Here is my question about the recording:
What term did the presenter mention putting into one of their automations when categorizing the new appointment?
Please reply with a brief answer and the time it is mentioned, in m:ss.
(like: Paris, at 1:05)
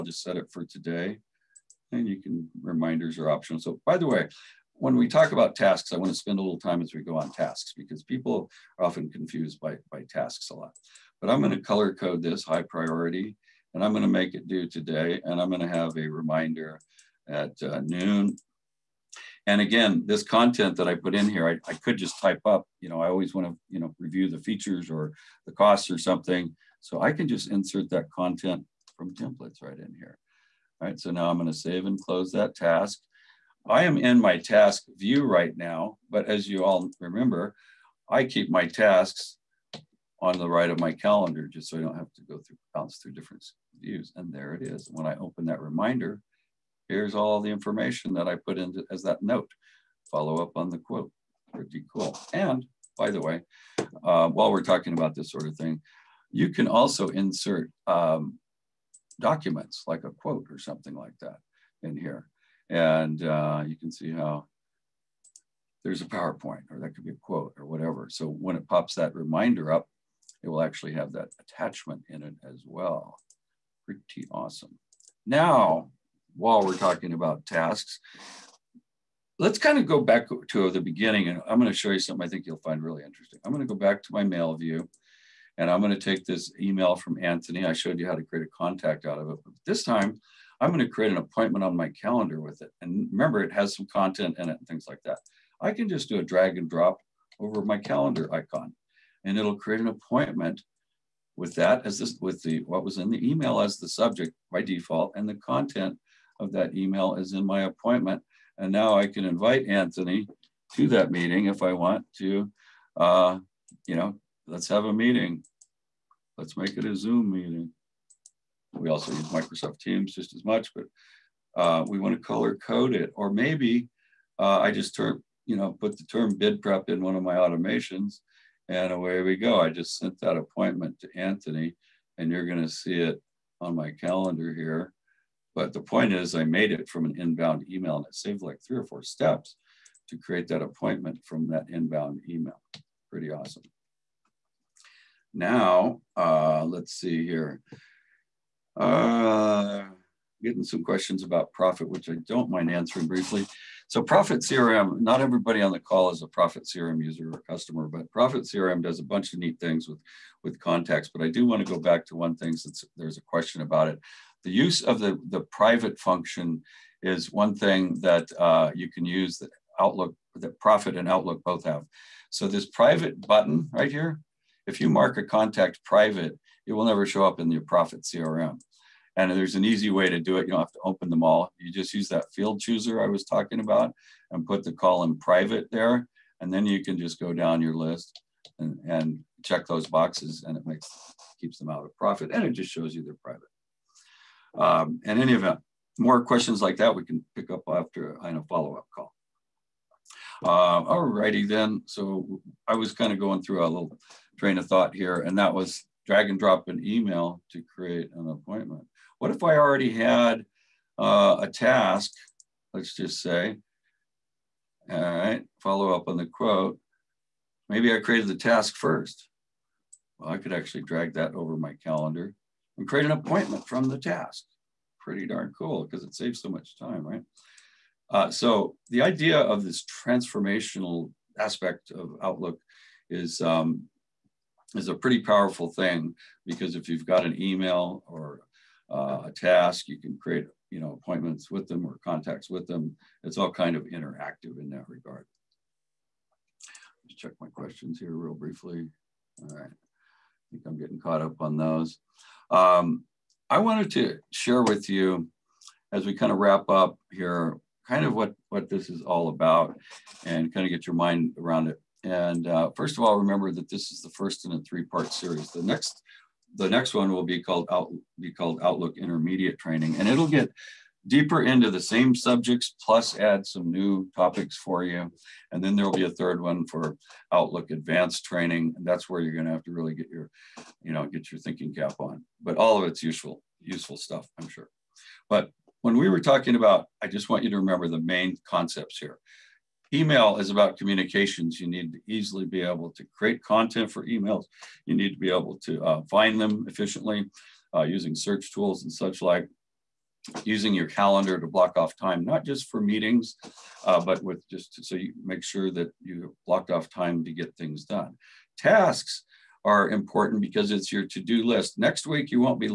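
bid prep, at 2:06.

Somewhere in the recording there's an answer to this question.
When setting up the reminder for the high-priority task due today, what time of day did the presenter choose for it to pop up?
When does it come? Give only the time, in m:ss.
0:17.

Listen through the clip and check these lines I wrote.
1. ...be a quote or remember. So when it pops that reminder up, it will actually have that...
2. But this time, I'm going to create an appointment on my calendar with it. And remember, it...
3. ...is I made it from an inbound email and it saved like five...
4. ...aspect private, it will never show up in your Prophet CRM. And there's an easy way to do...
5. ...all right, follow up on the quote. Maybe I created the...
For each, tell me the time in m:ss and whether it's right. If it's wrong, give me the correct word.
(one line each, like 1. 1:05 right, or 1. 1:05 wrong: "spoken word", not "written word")
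1. 1:07 wrong: "whatever", not "remember"
2. 1:29 right
3. 2:16 wrong: "three", not "five"
4. 2:55 wrong: "contact", not "aspect"
5. 3:34 right.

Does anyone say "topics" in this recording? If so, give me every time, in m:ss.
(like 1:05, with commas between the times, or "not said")
4:34.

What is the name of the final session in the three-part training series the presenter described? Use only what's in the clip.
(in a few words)
Outlook Advanced Training.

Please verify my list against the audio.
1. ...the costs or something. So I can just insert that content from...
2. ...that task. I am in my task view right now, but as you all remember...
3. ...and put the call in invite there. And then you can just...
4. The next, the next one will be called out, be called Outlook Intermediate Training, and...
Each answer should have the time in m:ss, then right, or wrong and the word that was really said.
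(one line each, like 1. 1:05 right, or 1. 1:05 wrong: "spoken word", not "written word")
1. 0:25 right
2. 0:32 right
3. 3:04 wrong: "private", not "invite"
4. 4:25 right.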